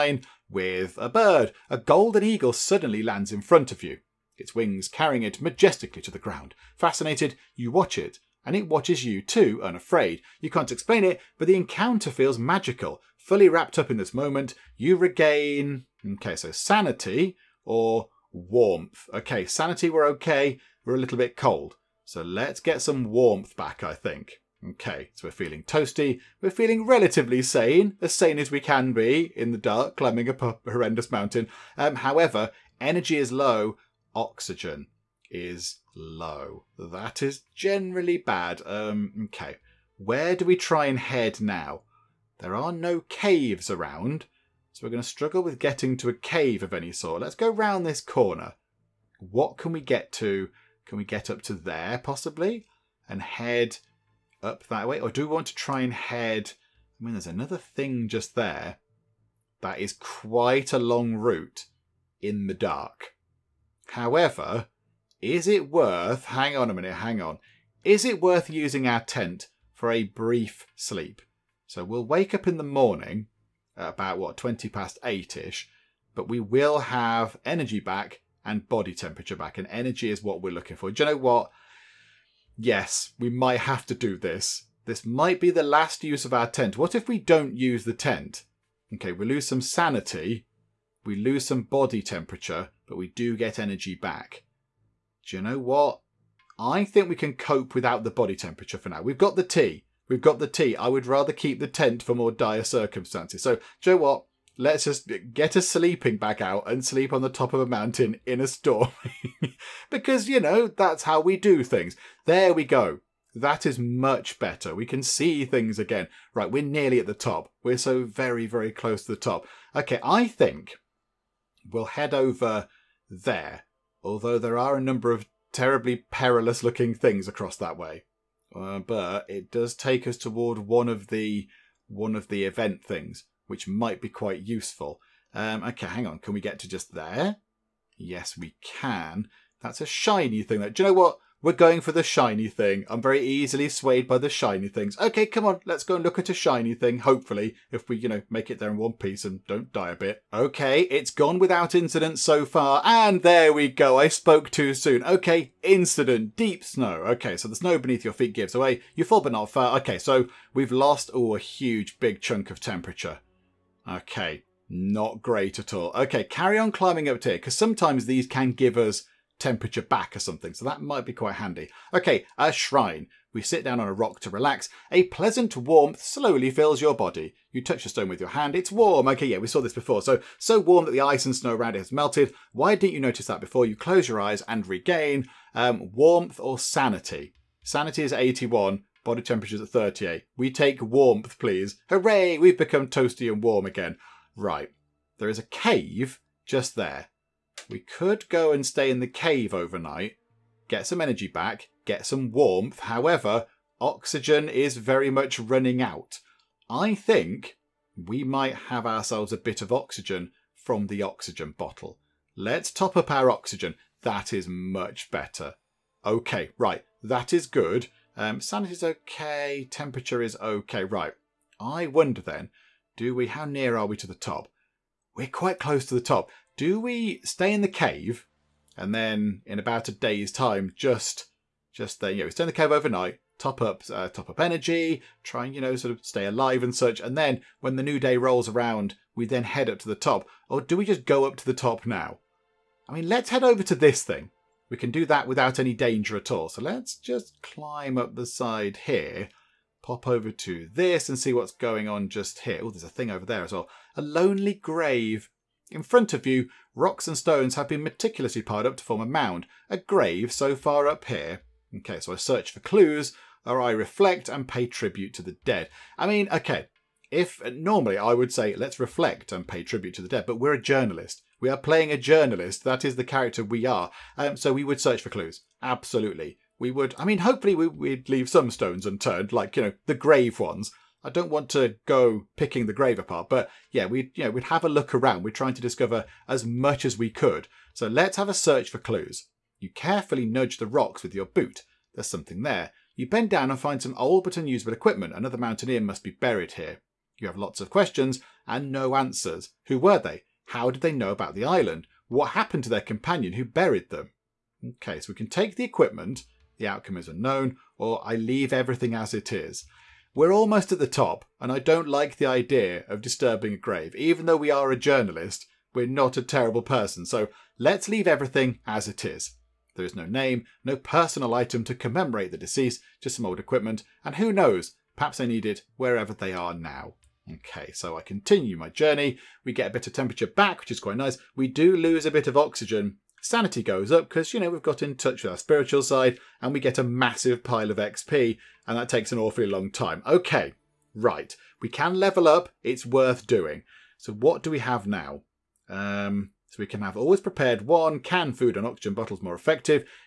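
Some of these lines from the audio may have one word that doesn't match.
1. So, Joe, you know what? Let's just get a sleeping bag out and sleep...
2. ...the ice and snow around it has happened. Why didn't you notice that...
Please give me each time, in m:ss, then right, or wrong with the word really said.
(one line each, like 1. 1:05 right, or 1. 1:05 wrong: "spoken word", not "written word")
1. 1:43 right
2. 3:00 wrong: "melted", not "happened".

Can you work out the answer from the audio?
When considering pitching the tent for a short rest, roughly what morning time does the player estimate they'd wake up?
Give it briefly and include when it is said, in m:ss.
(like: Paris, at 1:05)
8:20, at 1:14.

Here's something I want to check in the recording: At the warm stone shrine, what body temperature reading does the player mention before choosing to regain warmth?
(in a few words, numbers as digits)
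38.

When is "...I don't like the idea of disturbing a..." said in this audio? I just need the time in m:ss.
5:11.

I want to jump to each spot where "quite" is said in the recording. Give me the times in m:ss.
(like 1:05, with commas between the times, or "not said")
0:59, 2:14, 2:51, 3:45, 5:30.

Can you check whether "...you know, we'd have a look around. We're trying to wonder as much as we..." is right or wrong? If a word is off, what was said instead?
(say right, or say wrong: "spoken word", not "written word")
wrong: "discover", not "wonder".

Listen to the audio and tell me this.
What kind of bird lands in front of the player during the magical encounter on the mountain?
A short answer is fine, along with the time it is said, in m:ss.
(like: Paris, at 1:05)
Golden eagle, at 0:01.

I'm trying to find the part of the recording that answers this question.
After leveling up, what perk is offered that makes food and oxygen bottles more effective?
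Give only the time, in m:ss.
5:46.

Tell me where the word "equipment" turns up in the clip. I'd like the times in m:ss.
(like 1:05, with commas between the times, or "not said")
4:54, 5:05, 5:23.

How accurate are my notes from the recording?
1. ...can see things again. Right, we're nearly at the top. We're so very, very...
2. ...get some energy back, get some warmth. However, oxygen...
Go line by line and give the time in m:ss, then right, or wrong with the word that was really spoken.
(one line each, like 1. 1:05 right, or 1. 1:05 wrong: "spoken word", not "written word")
1. 1:54 right
2. 3:20 right.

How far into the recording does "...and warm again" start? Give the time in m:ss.
3:13.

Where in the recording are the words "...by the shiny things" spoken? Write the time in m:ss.
2:24.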